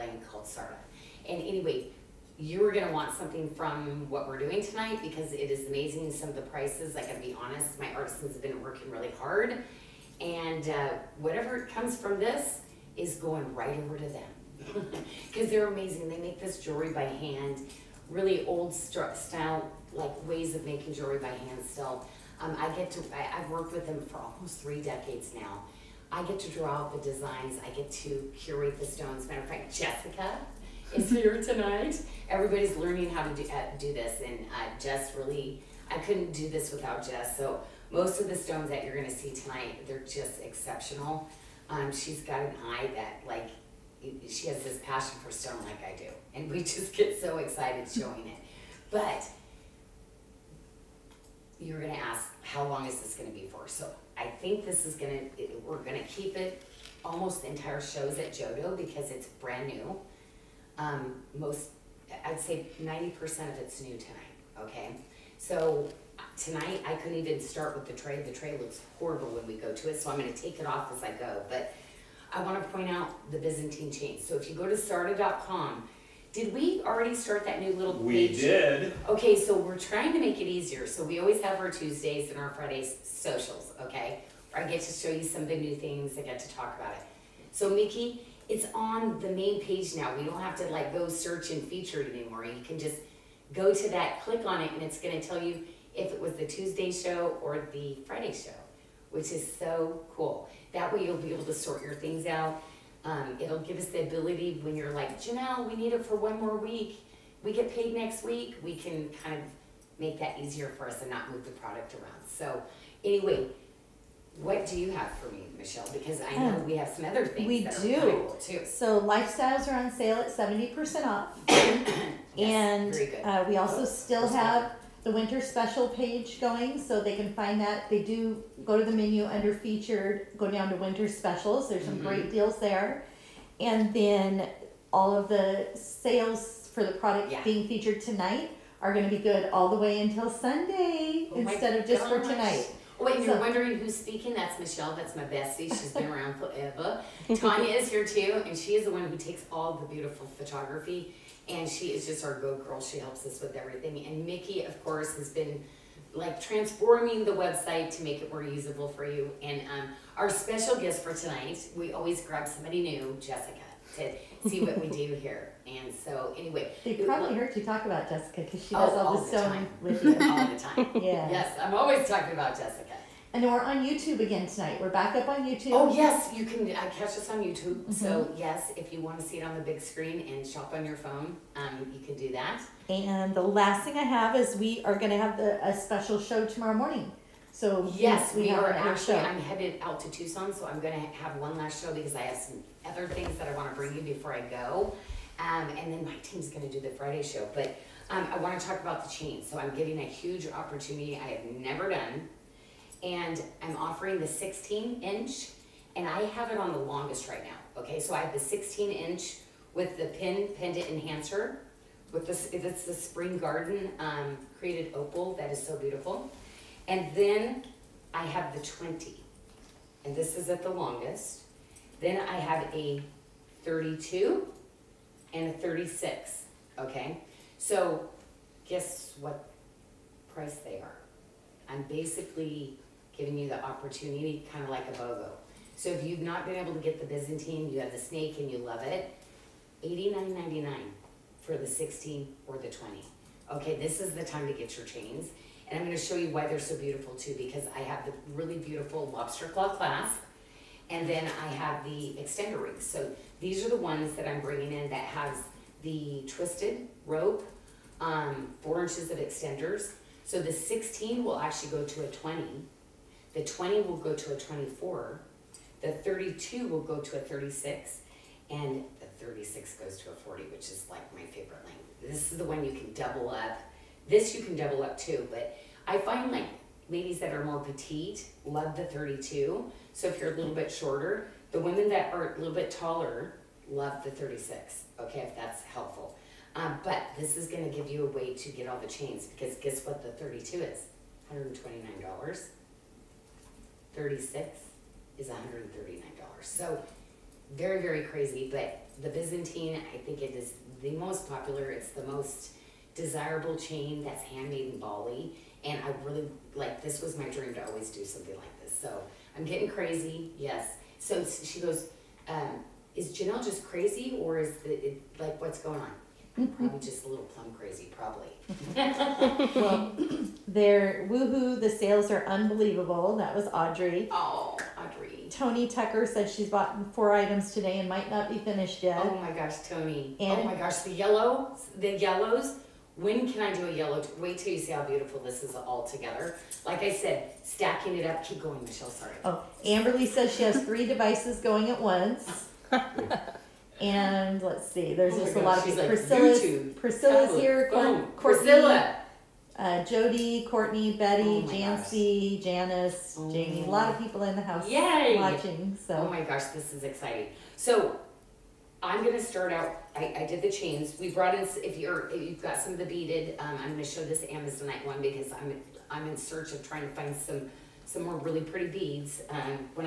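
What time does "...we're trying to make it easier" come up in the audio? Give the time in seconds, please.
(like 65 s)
79 s.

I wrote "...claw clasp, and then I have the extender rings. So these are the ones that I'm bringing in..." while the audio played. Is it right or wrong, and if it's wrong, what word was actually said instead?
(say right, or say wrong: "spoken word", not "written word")
right.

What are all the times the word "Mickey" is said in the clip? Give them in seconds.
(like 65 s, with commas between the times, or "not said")
87 s, 154 s.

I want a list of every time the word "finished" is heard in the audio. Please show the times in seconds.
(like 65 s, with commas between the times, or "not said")
328 s.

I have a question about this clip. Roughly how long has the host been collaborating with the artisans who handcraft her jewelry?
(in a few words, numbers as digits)
almost three decades.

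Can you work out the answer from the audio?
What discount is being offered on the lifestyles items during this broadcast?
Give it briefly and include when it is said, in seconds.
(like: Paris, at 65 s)
70% off, at 120 s.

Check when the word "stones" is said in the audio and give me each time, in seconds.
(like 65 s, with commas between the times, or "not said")
28 s, 38 s, 45 s.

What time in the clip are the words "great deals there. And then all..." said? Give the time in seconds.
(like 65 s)
132 s.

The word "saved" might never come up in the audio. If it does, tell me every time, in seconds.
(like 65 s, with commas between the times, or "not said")
not said.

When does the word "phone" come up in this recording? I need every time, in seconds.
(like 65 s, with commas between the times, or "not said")
181 s, 347 s.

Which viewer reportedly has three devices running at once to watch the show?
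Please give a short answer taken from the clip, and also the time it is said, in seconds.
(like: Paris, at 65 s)
Amberly, at 339 s.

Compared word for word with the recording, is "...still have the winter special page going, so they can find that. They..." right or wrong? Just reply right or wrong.
right.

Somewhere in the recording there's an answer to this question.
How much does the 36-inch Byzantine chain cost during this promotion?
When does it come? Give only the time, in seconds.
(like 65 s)
295 s.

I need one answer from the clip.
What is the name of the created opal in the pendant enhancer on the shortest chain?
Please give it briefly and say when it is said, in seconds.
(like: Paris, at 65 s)
spring garden, at 212 s.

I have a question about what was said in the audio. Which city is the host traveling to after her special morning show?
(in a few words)
Tucson.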